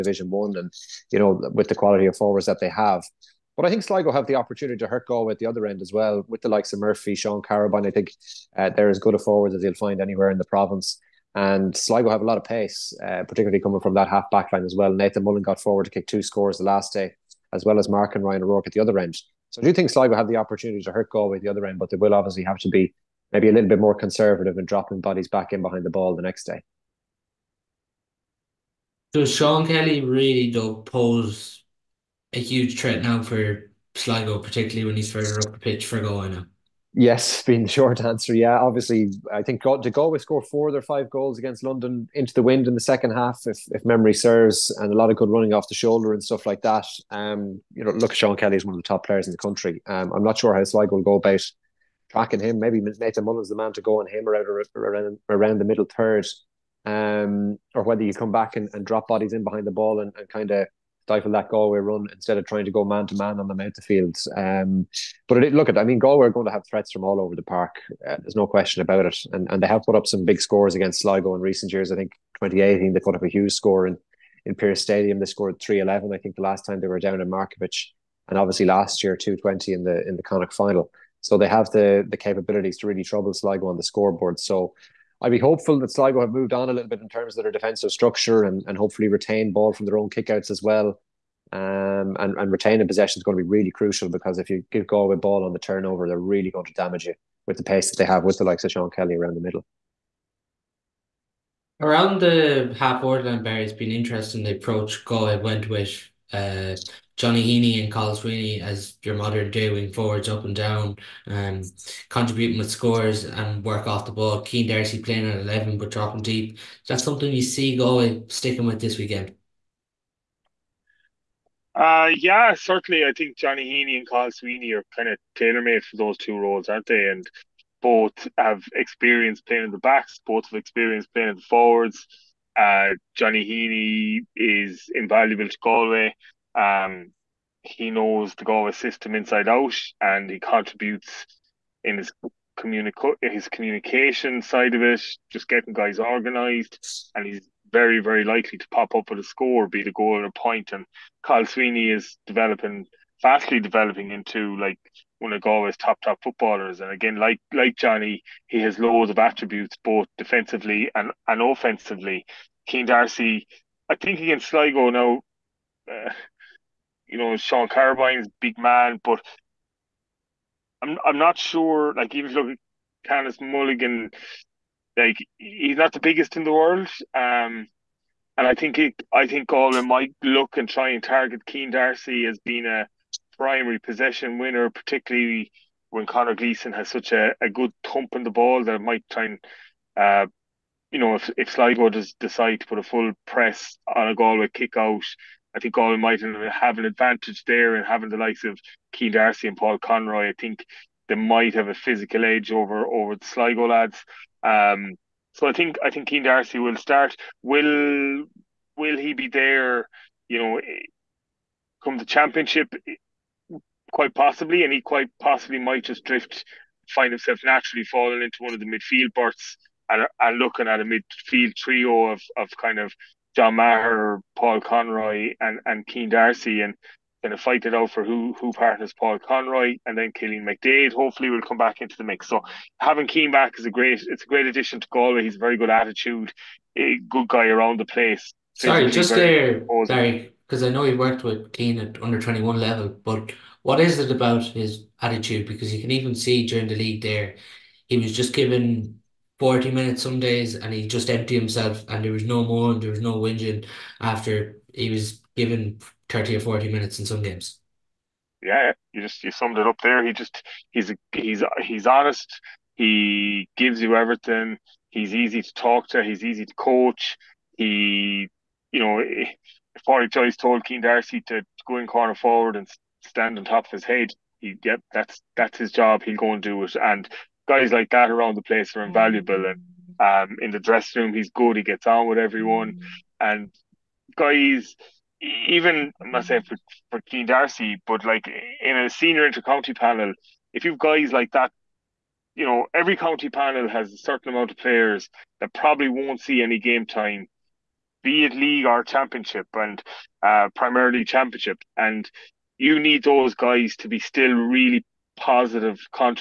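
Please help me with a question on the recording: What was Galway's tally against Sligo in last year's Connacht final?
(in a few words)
2-20.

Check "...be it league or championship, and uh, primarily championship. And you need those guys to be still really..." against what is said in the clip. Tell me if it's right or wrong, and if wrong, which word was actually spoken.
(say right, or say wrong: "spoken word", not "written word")
right.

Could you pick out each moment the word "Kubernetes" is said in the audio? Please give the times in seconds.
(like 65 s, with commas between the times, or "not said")
not said.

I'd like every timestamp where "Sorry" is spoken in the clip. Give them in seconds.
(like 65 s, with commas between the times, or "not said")
238 s.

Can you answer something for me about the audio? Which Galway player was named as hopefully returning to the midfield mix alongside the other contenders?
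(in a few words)
Cillian McDaid.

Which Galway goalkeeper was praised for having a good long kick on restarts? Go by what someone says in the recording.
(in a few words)
Conor Gleeson.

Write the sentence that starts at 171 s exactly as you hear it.
Like even look at Canice Mulligan, like he's not the biggest in the world.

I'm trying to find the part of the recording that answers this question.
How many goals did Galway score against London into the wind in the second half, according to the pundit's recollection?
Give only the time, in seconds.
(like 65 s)
40 s.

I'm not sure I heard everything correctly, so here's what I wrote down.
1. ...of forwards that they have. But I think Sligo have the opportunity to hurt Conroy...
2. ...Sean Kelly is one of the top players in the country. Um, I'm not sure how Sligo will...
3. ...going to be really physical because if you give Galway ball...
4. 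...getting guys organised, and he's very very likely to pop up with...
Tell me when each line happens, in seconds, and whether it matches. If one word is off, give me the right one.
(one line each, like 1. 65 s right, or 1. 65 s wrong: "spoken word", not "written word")
1. 2 s wrong: "Galway", not "Conroy"
2. 48 s right
3. 93 s wrong: "crucial", not "physical"
4. 145 s right.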